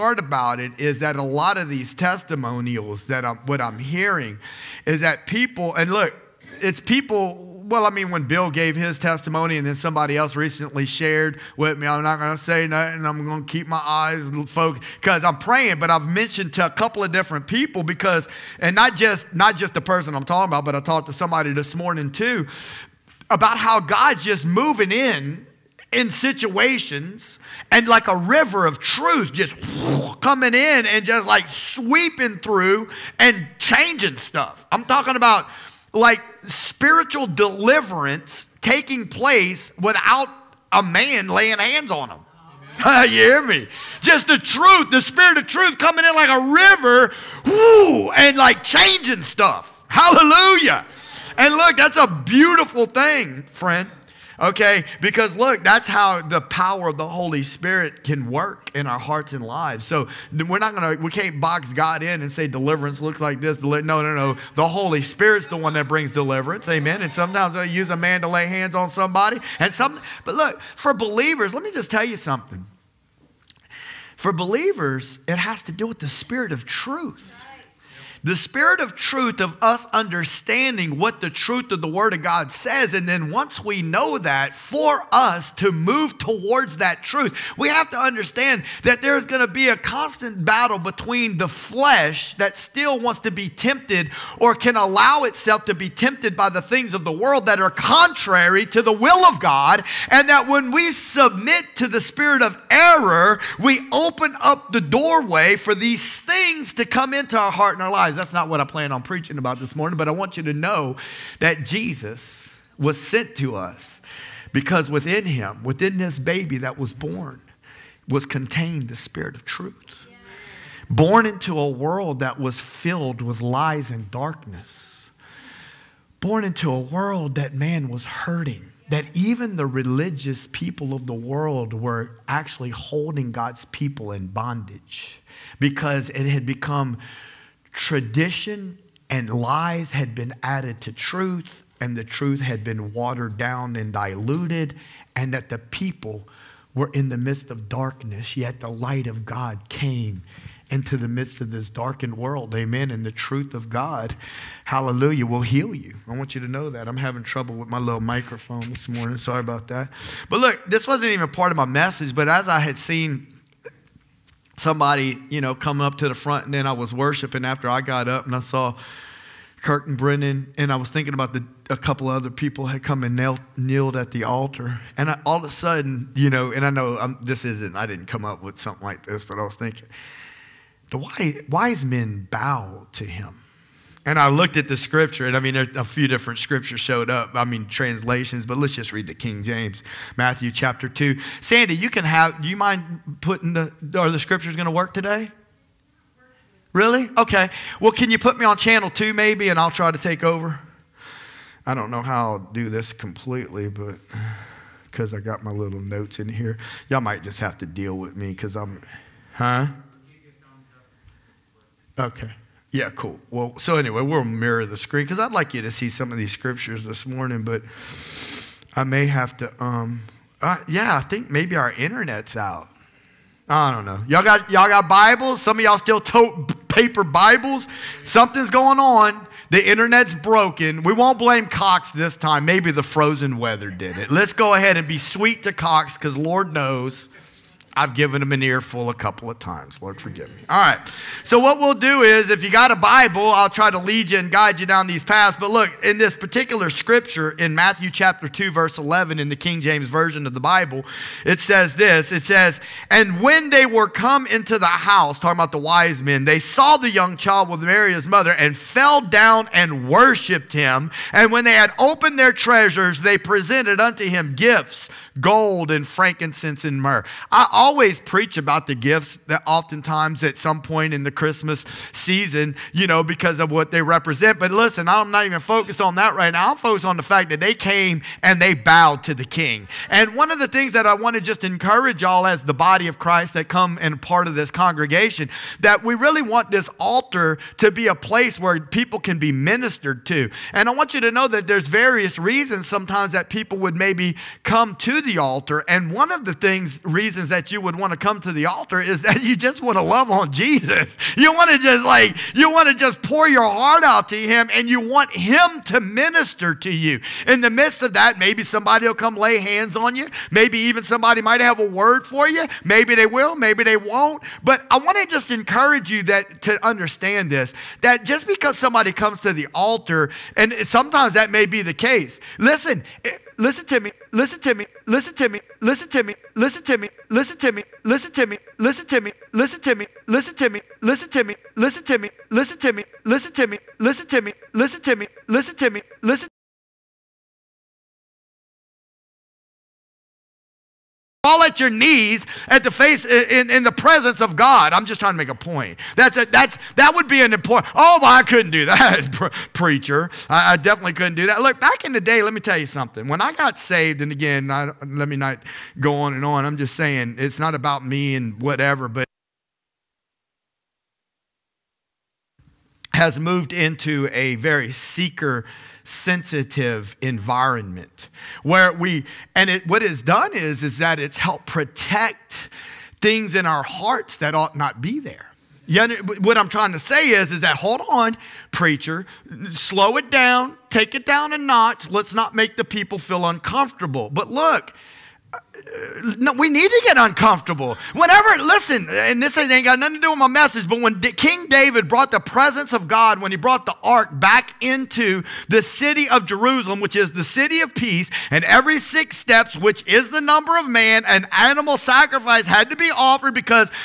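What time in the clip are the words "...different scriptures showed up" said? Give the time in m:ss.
3:06.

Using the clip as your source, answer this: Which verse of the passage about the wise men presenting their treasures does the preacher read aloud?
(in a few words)
Verse 11.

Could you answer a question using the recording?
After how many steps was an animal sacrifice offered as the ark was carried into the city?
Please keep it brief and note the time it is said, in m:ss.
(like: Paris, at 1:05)
6, at 6:38.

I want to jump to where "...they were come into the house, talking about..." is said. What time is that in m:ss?
4:13.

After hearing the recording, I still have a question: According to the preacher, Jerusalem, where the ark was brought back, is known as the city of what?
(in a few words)
Peace.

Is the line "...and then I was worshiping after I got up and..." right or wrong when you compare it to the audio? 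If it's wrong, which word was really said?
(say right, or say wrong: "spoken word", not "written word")
right.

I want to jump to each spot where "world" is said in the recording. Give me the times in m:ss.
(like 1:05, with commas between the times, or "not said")
1:37, 2:01, 2:06, 2:11, 2:32.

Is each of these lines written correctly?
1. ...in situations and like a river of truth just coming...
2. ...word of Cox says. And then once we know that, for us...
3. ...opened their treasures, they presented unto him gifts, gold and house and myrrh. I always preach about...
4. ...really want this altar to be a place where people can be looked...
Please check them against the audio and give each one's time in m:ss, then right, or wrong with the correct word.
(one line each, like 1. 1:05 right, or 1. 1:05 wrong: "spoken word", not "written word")
1. 0:25 right
2. 1:21 wrong: "God", not "Cox"
3. 4:21 wrong: "frankincense", not "house"
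4. 4:45 wrong: "ministered", not "looked".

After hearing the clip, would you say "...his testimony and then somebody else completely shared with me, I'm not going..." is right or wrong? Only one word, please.
wrong.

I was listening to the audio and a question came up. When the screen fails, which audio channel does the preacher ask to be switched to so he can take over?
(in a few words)
Channel two.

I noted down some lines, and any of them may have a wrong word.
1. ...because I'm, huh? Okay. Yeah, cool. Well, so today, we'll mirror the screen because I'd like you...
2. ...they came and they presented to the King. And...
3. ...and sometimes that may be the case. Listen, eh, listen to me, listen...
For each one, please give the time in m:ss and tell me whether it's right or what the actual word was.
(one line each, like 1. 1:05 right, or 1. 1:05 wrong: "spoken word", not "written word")
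1. 3:28 wrong: "anyway", not "today"
2. 4:37 wrong: "bowed", not "presented"
3. 5:20 right.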